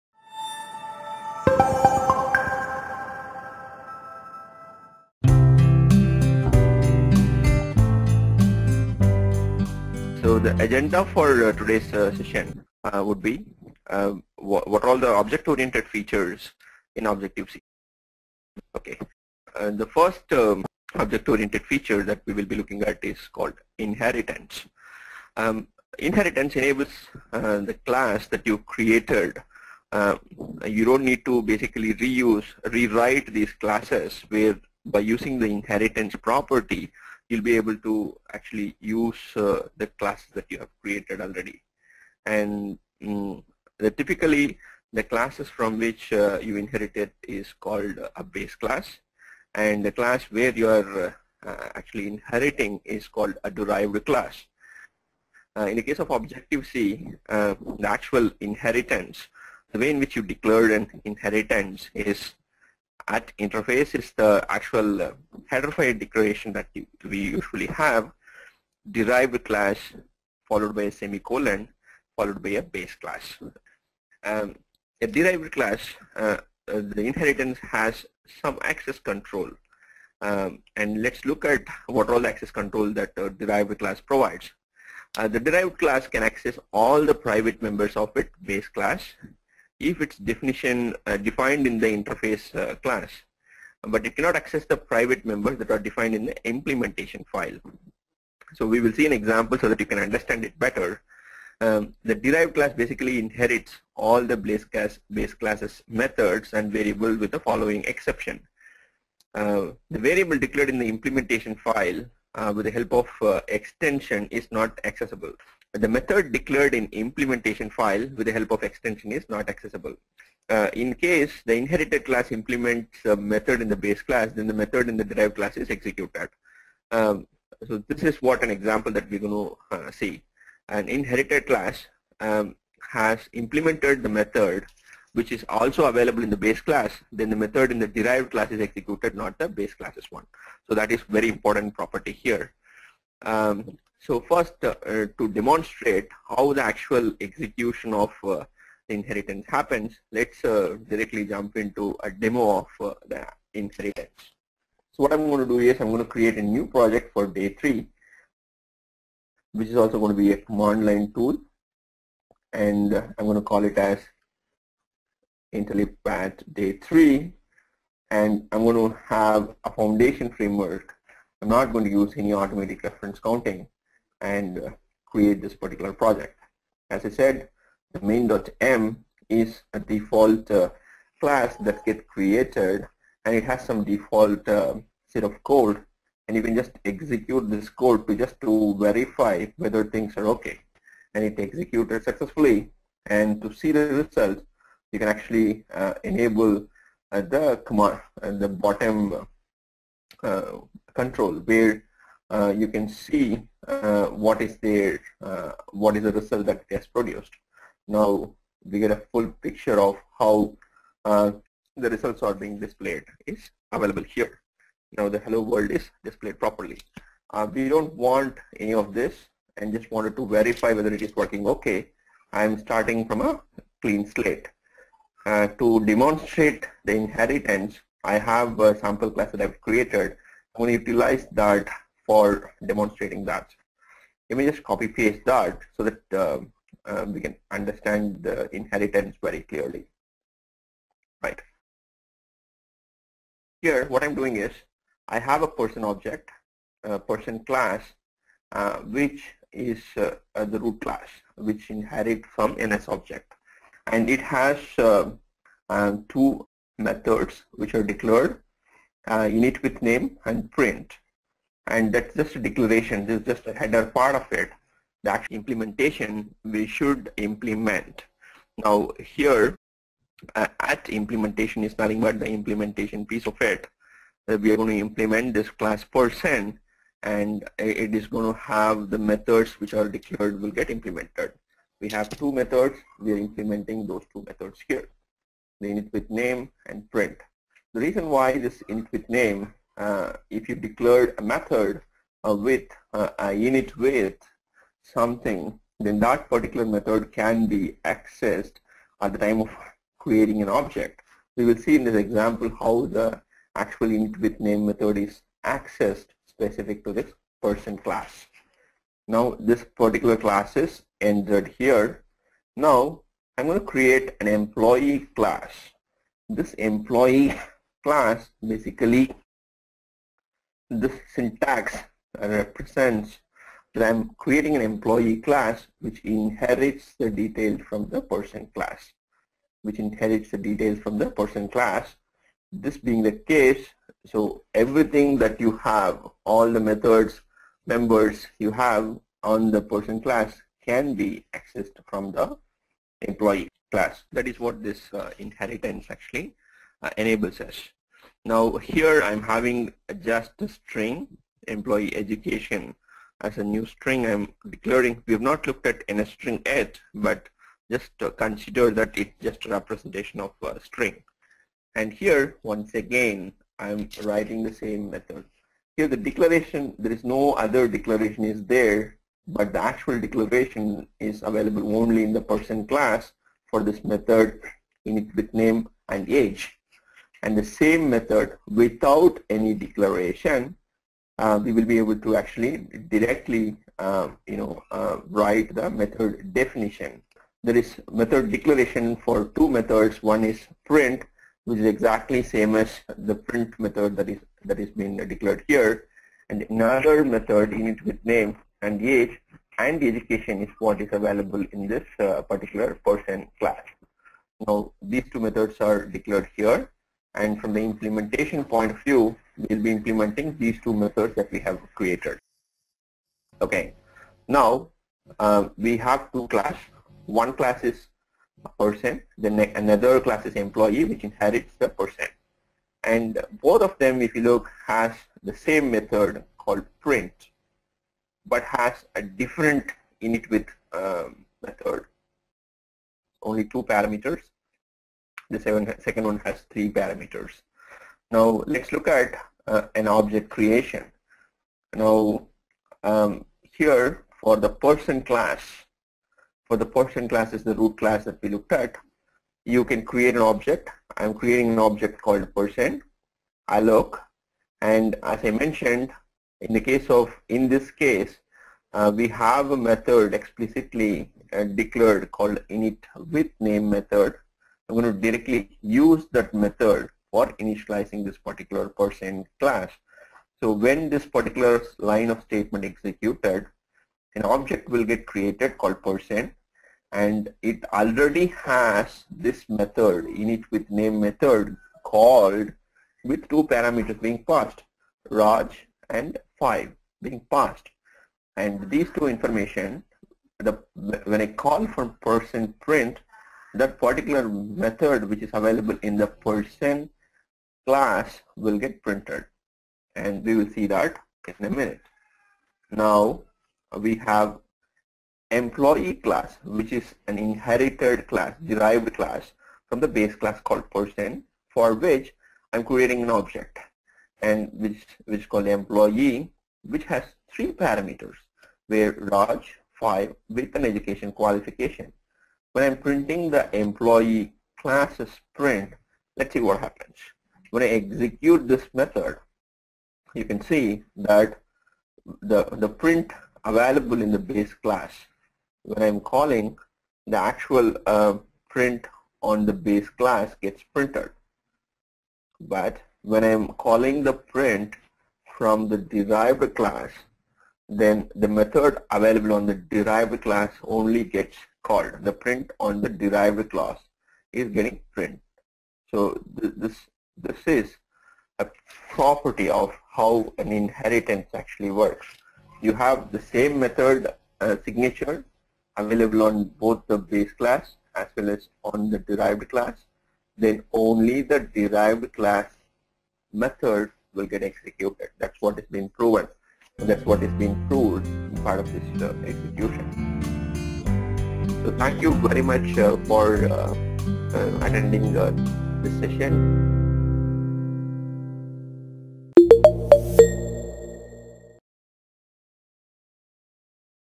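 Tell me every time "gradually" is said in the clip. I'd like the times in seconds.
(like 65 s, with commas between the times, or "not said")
not said.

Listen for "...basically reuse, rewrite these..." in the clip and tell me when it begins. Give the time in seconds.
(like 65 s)
31 s.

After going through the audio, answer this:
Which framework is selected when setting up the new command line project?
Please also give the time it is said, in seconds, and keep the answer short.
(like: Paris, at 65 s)
Foundation, at 169 s.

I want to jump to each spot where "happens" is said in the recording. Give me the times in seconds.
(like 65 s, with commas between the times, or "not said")
149 s, 526 s.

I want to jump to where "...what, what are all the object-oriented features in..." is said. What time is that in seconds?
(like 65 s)
14 s.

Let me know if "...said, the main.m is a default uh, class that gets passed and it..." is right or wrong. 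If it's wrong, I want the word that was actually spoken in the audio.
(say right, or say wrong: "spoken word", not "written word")
wrong: "created", not "passed".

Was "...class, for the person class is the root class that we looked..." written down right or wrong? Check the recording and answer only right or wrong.
right.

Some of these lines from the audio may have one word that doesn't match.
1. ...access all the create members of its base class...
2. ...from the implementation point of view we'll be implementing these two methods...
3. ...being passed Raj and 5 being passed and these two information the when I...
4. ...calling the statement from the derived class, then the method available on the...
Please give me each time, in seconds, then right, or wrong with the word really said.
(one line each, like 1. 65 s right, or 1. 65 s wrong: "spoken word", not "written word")
1. 86 s wrong: "private", not "create"
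2. 407 s right
3. 484 s right
4. 543 s wrong: "print", not "statement".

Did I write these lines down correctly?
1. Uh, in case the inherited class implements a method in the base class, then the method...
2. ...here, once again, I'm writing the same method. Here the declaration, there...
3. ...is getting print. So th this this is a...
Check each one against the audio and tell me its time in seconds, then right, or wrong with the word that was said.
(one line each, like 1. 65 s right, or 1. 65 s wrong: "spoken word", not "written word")
1. 120 s right
2. 361 s right
3. 554 s right.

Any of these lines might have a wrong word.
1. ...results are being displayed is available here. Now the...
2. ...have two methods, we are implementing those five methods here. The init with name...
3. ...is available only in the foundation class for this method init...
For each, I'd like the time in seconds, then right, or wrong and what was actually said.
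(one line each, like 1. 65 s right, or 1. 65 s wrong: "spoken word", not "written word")
1. 211 s right
2. 281 s wrong: "two", not "five"
3. 370 s wrong: "person", not "foundation".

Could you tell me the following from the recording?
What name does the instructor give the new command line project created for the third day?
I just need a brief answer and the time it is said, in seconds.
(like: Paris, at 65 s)
Intellipaat day three, at 165 s.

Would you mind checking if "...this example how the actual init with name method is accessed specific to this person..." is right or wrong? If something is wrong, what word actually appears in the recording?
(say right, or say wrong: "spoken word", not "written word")
right.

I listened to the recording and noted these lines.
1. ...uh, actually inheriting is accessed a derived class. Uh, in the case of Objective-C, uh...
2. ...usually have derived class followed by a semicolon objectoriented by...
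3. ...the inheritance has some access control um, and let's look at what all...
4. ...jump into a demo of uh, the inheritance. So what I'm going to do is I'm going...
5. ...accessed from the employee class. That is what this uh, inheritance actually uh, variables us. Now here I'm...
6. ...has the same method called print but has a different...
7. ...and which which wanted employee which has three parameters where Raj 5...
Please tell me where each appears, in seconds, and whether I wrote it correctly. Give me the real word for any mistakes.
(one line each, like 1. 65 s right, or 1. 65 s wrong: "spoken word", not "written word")
1. 51 s wrong: "called", not "accessed"
2. 67 s wrong: "followed", not "objectoriented"
3. 76 s right
4. 151 s right
5. 341 s wrong: "enables", not "variables"
6. 424 s right
7. 514 s wrong: "called", not "wanted".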